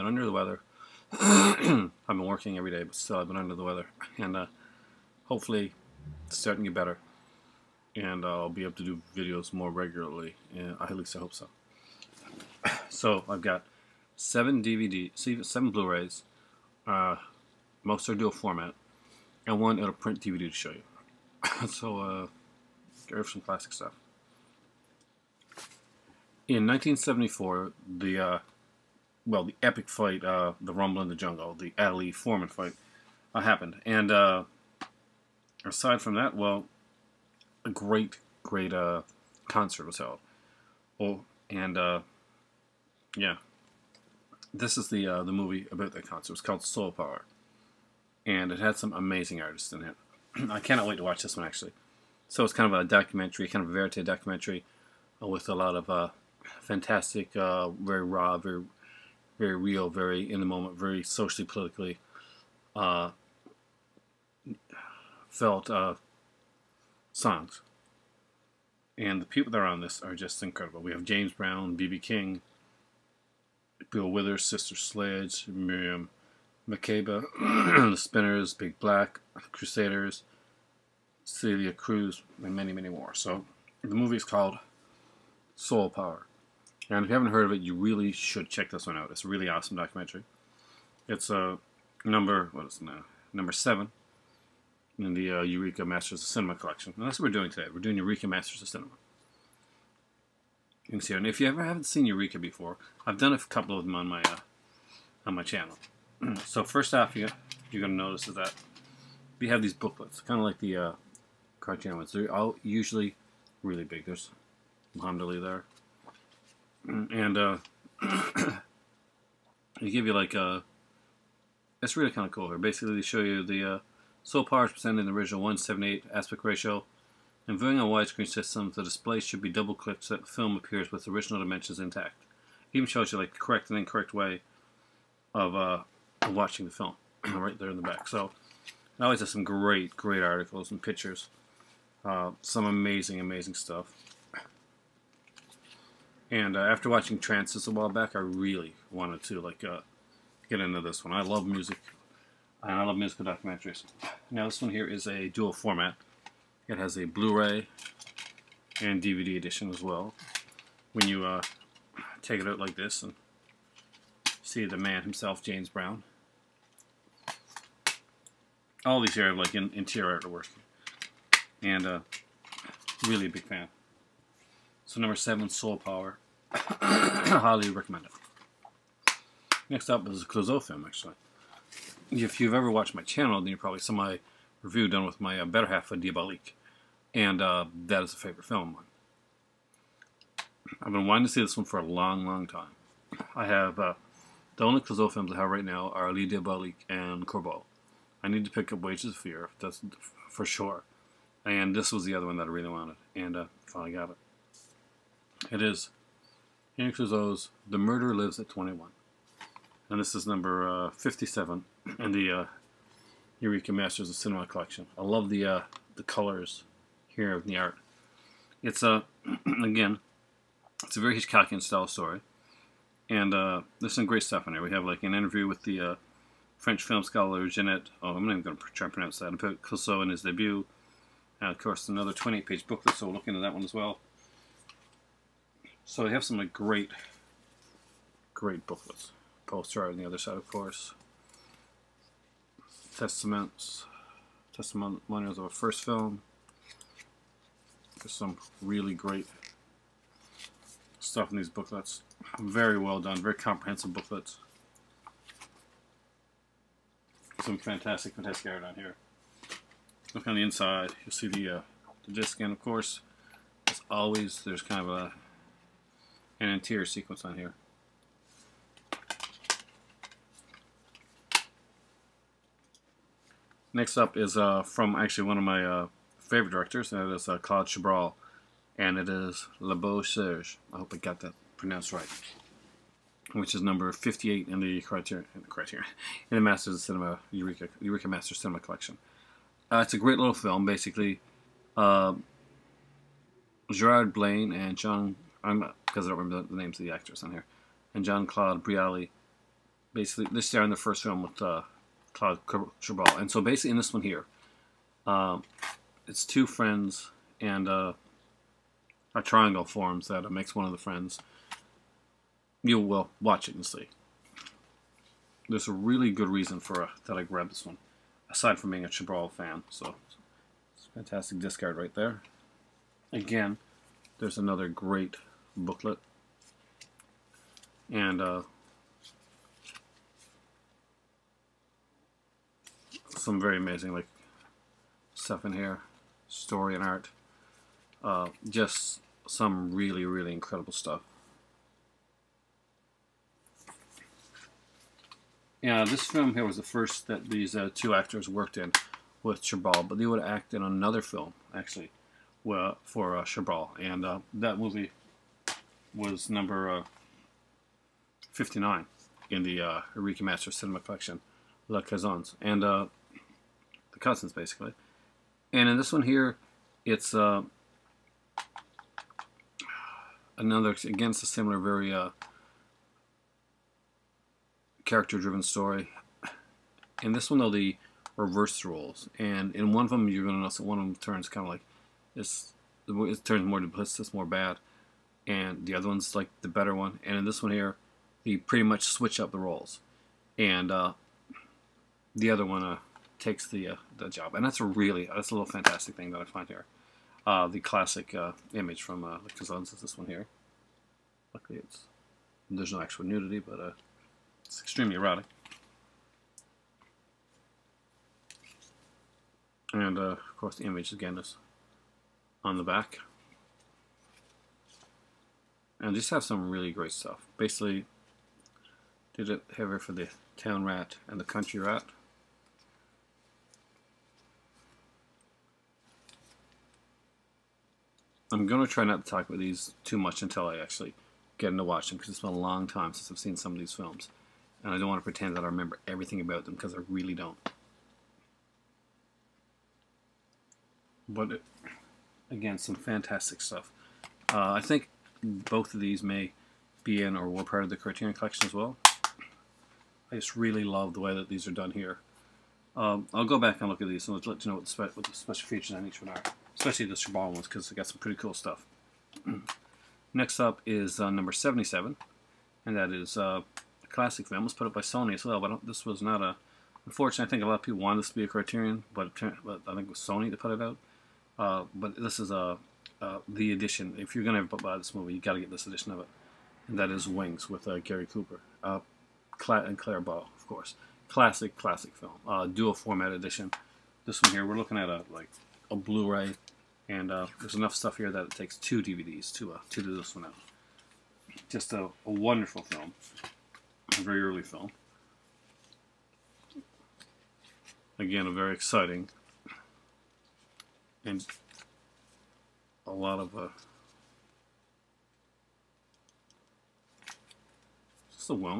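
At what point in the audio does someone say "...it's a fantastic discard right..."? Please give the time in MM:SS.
05:20.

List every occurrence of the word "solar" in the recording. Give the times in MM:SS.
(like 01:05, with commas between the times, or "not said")
02:04.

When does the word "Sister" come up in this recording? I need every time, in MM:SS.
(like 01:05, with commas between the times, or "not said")
01:14.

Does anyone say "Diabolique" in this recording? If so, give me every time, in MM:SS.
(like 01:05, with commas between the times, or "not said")
03:05, 03:16.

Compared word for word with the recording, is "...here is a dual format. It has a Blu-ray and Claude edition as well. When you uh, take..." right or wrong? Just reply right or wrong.
wrong.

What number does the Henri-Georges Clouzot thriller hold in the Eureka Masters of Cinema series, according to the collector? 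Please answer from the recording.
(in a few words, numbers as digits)
57.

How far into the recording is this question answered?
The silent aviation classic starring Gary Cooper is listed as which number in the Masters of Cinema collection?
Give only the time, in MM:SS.
07:41.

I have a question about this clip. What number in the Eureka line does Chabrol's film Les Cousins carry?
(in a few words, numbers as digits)
59.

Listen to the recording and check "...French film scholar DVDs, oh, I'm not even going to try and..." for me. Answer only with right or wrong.
wrong.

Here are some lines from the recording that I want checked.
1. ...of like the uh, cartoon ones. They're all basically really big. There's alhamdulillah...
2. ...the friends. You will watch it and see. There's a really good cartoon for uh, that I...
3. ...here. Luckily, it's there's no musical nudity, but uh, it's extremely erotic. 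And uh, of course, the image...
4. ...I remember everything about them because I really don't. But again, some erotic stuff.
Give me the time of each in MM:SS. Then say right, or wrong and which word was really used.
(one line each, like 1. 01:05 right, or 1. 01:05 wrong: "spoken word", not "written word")
1. 01:50 wrong: "usually", not "basically"
2. 05:10 wrong: "reason", not "cartoon"
3. 06:40 wrong: "actual", not "musical"
4. 07:15 wrong: "fantastic", not "erotic".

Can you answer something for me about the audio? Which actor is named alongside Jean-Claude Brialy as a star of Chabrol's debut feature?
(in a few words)
Gerard Blain.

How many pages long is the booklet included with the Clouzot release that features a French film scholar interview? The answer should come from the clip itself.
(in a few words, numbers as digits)
28.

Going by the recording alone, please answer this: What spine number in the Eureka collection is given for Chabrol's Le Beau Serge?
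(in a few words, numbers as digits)
58.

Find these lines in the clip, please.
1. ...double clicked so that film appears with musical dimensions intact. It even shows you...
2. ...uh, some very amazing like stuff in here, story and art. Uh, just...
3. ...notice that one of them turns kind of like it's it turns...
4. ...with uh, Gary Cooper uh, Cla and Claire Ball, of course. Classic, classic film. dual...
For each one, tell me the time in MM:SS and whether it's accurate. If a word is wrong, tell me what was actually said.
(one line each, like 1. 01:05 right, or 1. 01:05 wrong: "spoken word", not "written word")
1. 02:09 wrong: "original", not "musical"
2. 05:28 right
3. 06:20 right
4. 07:57 right.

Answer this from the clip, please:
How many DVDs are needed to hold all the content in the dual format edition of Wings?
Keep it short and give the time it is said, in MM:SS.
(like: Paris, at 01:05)
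2, at 08:08.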